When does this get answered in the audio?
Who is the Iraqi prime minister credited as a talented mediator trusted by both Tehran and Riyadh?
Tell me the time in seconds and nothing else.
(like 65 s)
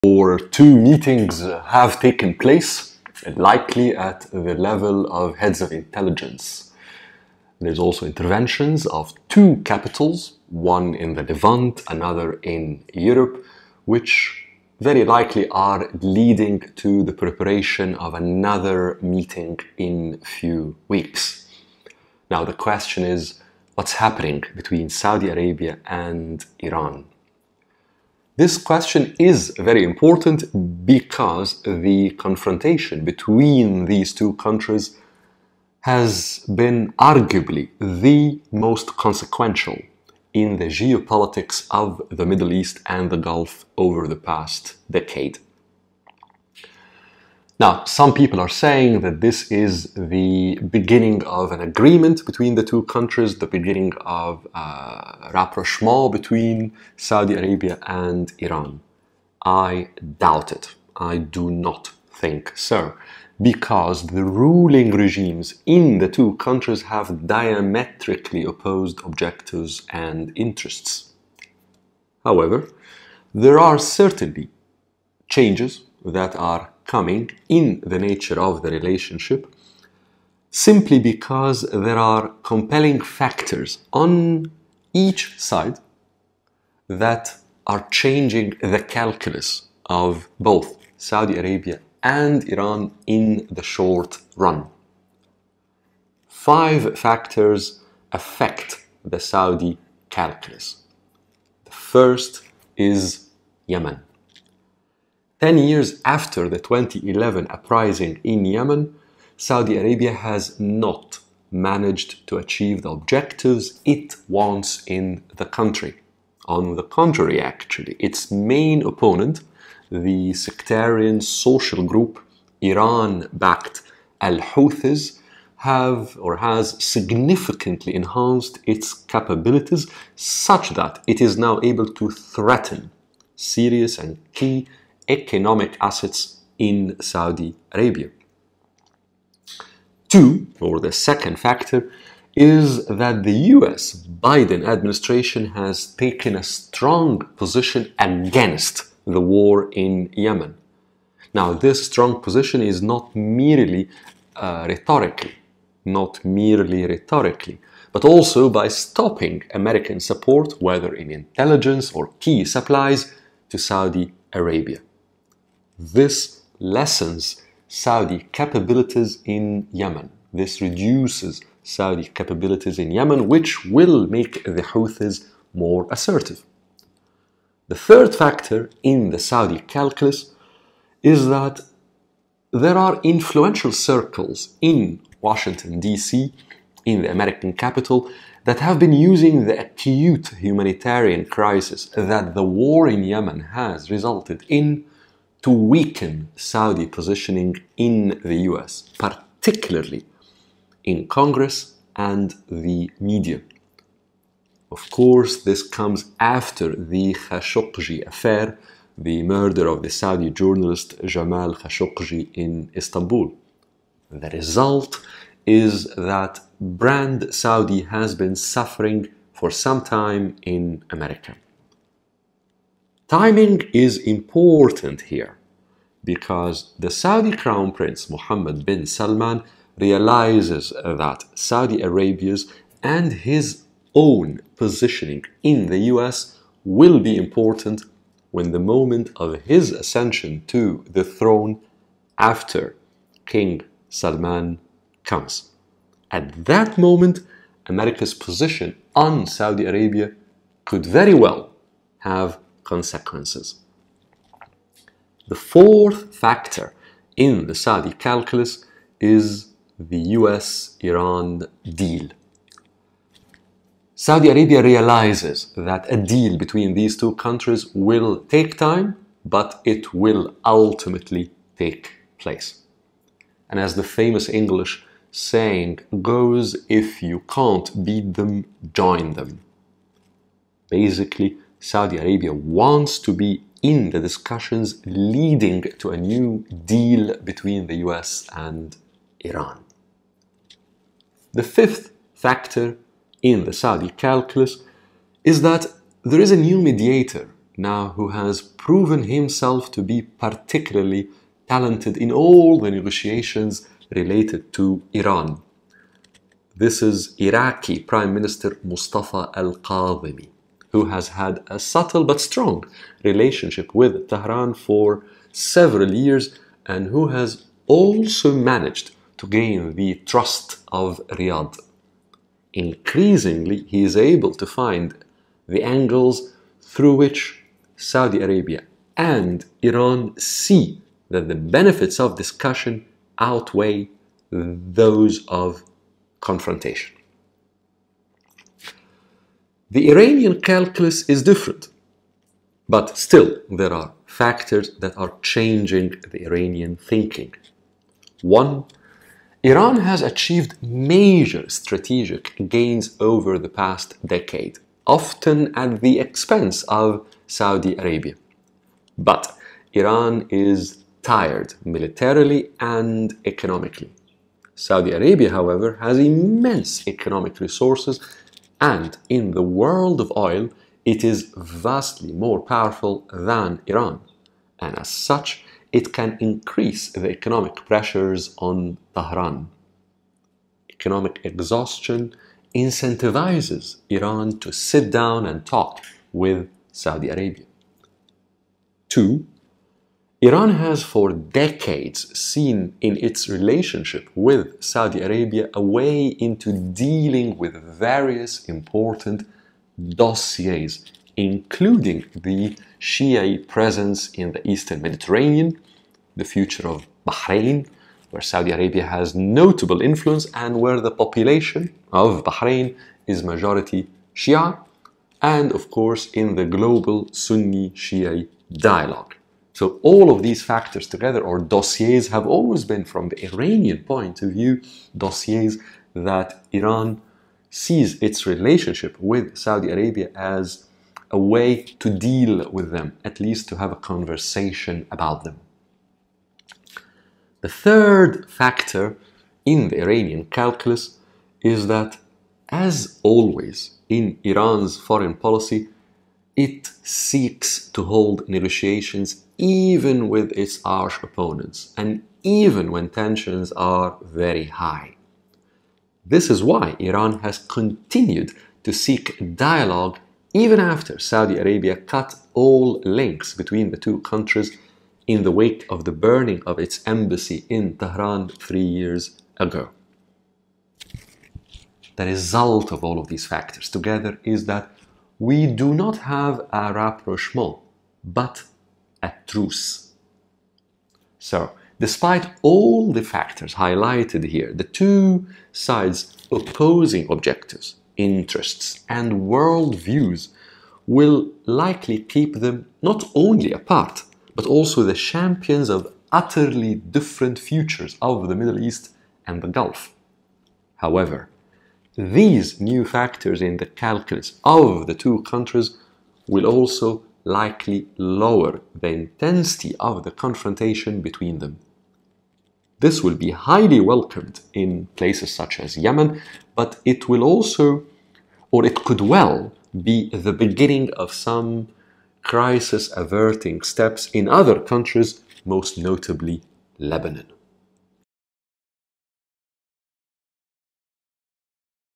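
308 s.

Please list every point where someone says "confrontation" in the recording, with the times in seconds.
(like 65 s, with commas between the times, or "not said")
32 s, 336 s, 510 s.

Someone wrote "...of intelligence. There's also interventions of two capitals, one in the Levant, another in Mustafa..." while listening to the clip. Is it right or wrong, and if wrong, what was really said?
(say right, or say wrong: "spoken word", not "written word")
wrong: "Europe", not "Mustafa".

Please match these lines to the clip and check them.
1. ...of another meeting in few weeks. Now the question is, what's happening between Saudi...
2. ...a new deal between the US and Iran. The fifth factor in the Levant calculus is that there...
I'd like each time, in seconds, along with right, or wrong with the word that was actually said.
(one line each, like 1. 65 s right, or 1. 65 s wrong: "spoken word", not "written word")
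1. 17 s right
2. 285 s wrong: "Saudi", not "Levant".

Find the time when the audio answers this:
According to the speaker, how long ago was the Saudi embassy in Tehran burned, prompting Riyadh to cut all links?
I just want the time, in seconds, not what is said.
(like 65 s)
468 s.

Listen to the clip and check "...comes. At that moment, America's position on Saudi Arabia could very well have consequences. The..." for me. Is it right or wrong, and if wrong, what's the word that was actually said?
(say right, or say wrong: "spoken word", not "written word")
right.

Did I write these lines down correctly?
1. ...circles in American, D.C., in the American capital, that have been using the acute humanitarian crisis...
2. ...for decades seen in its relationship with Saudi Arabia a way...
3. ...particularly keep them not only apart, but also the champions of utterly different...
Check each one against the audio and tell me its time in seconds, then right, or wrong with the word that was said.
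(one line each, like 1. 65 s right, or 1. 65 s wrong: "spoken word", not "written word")
1. 183 s wrong: "Washington", not "American"
2. 390 s right
3. 491 s wrong: "likely", not "particularly".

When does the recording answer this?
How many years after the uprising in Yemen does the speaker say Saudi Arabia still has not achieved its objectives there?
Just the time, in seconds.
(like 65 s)
105 s.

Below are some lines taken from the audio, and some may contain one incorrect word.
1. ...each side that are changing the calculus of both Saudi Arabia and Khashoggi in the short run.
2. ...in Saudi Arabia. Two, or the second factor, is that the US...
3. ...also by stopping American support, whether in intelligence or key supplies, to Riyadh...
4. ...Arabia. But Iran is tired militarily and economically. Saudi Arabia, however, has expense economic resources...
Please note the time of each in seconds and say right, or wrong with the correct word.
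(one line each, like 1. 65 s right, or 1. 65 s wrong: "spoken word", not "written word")
1. 85 s wrong: "Iran", not "Khashoggi"
2. 136 s right
3. 158 s wrong: "Saudi", not "Riyadh"
4. 357 s wrong: "immense", not "expense".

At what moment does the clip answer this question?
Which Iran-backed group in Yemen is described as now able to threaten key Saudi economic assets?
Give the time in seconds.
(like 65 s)
124 s.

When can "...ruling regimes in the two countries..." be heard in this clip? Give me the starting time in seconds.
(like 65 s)
64 s.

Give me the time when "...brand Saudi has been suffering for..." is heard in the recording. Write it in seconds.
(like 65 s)
216 s.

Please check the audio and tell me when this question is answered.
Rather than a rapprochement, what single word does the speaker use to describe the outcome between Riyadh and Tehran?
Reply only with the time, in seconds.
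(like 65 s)
479 s.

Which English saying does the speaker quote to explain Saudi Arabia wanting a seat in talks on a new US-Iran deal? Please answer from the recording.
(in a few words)
If you can't beat them, join them.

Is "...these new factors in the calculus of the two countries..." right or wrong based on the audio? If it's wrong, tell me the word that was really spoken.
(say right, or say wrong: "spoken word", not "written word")
right.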